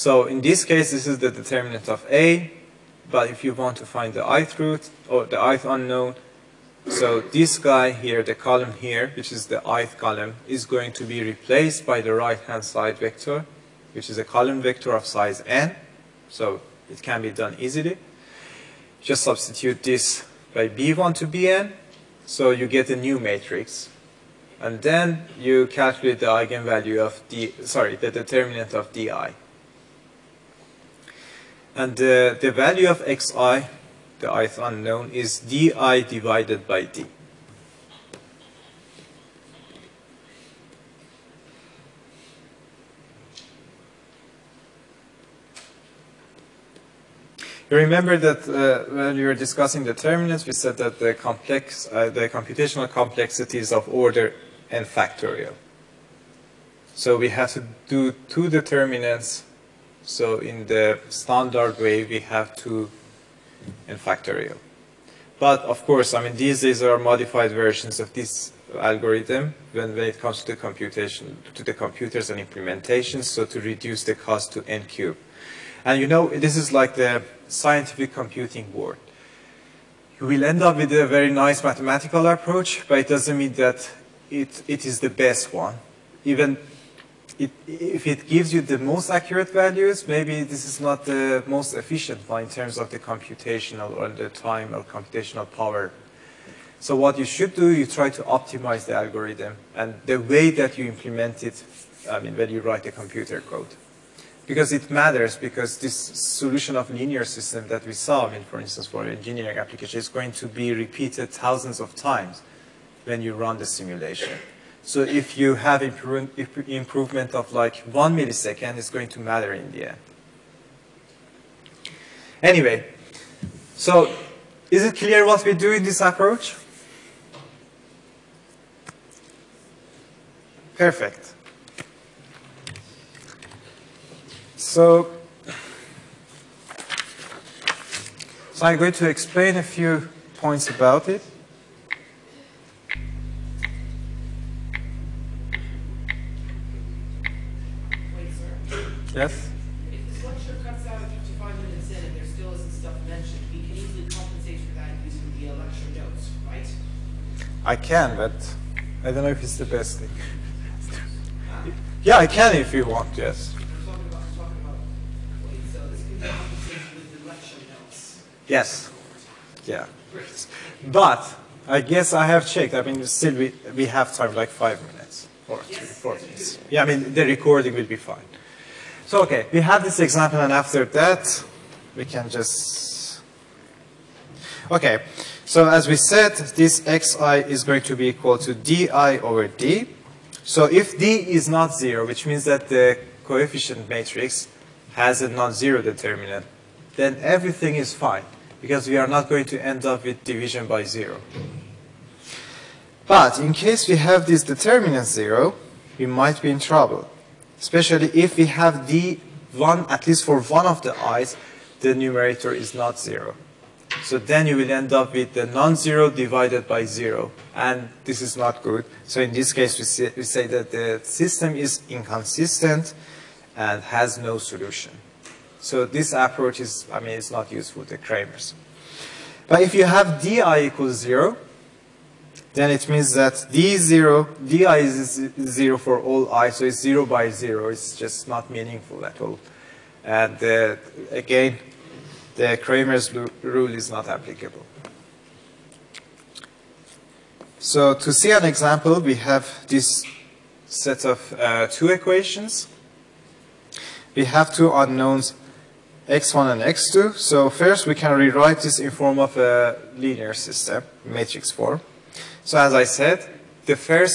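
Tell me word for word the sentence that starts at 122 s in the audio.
Anyway, so is it clear what we do in this approach?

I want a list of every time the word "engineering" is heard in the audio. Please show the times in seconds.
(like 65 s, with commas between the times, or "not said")
109 s.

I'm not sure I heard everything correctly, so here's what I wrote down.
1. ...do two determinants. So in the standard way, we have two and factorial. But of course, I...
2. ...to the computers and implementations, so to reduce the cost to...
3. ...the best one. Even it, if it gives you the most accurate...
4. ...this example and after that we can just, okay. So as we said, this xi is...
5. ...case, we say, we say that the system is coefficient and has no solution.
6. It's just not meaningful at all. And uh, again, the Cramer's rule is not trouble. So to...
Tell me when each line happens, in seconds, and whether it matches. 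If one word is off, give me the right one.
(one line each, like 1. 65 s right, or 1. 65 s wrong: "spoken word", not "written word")
1. 57 s right
2. 71 s right
3. 84 s right
4. 179 s right
5. 219 s wrong: "inconsistent", not "coefficient"
6. 237 s wrong: "applicable", not "trouble".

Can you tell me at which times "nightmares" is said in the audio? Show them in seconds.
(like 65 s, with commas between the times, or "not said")
not said.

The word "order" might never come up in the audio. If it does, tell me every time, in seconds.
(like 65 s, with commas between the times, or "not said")
53 s.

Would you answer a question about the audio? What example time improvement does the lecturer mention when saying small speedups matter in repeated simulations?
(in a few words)
1 millisecond.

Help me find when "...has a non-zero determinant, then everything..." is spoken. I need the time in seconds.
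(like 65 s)
194 s.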